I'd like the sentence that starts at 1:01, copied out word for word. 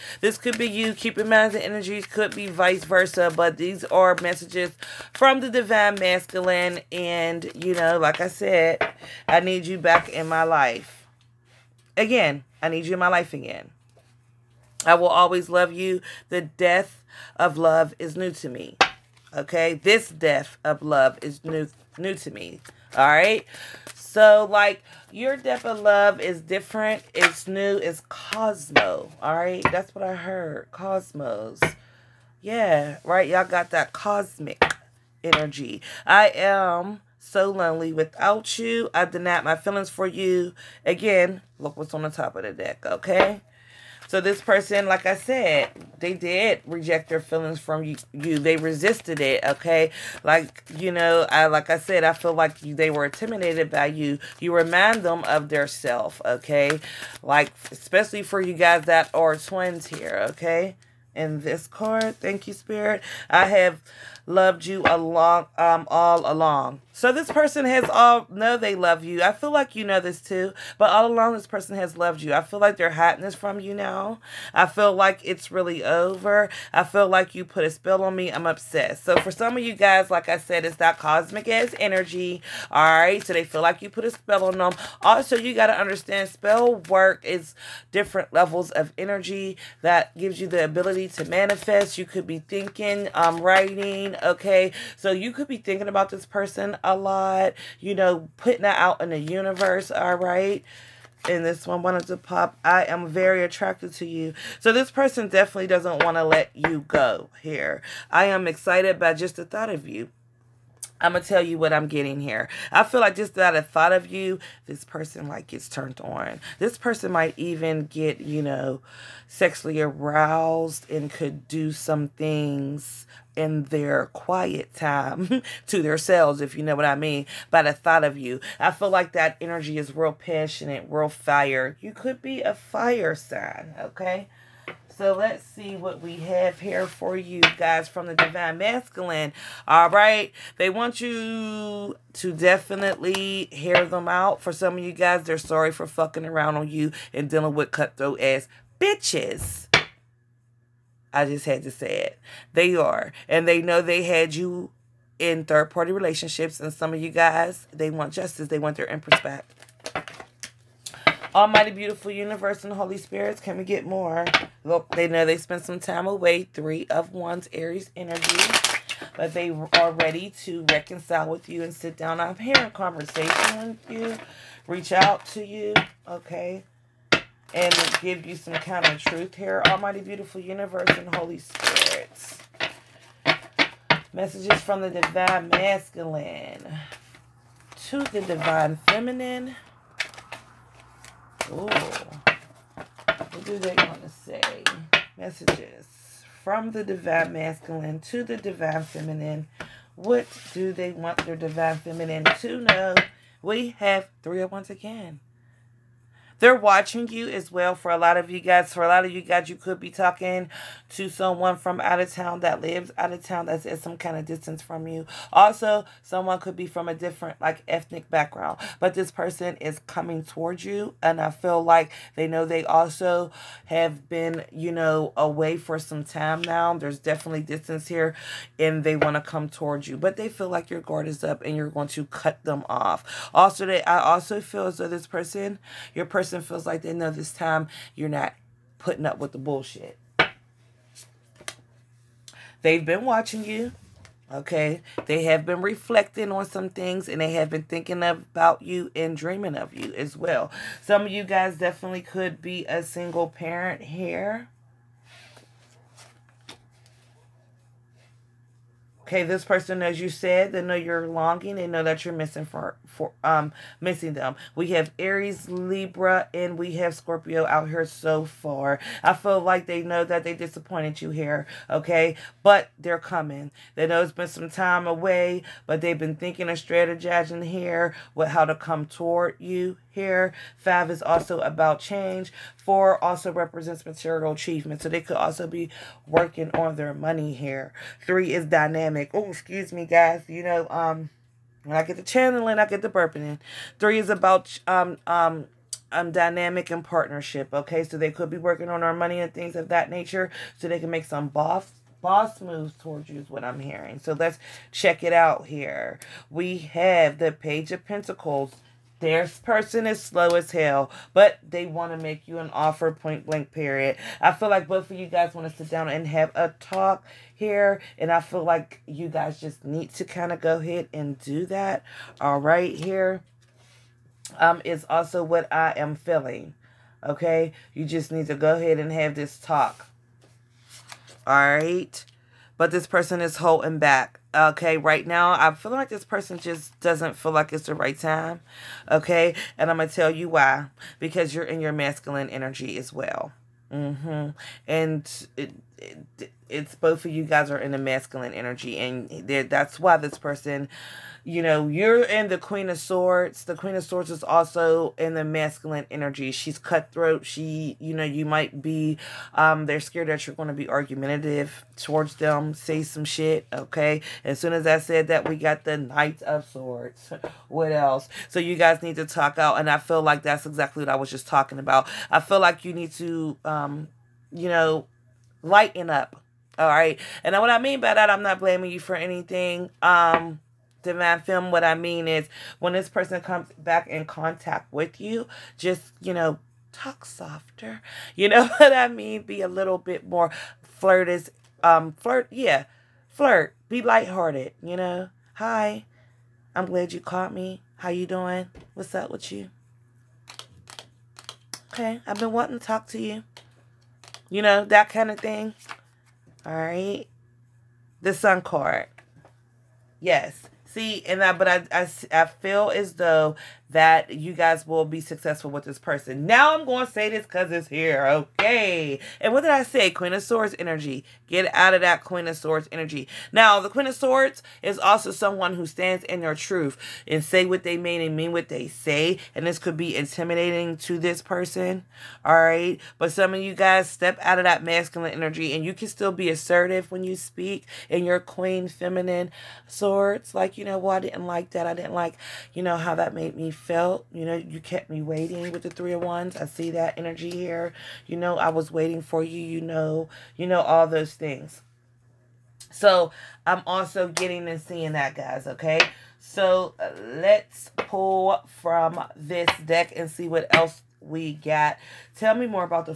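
in this card, thank you, Spirit.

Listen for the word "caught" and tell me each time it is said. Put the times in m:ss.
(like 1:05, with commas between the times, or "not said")
6:37.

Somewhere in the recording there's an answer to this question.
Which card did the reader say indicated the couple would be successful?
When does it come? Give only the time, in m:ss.
6:48.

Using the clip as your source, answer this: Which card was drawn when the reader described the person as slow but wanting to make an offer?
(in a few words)
Page of Pentacles.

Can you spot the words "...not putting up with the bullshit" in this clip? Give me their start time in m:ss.
3:58.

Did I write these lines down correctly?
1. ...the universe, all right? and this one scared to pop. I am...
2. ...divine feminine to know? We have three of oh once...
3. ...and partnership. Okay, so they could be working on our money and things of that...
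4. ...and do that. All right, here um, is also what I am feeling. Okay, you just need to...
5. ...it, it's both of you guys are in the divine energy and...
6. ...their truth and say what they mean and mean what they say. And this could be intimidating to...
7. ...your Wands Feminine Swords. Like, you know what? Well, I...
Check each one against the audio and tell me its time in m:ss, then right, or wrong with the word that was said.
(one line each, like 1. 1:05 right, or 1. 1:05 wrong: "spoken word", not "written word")
1. 1:39 wrong: "wanted", not "scared"
2. 3:21 right
3. 4:56 right
4. 5:20 right
5. 5:45 wrong: "masculine", not "divine"
6. 7:06 right
7. 7:18 wrong: "Queen", not "Wands".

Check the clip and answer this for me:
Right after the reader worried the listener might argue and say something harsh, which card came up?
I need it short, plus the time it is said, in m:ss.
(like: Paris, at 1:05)
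Knight of Swords, at 6:05.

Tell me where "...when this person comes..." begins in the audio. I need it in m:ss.
6:22.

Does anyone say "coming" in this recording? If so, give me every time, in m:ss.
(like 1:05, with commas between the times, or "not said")
3:39, 4:32.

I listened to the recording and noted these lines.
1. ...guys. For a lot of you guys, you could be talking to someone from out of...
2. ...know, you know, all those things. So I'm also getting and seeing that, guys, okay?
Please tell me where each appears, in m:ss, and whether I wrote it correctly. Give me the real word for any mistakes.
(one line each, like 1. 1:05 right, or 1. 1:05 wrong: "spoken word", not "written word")
1. 3:28 right
2. 7:29 right.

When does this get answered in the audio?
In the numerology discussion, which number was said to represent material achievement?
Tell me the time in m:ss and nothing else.
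4:42.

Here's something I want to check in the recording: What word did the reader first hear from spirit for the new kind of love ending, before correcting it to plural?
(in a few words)
Cosmo.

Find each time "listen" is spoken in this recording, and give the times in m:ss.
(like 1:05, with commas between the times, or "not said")
not said.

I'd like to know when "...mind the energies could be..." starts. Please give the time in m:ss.
0:01.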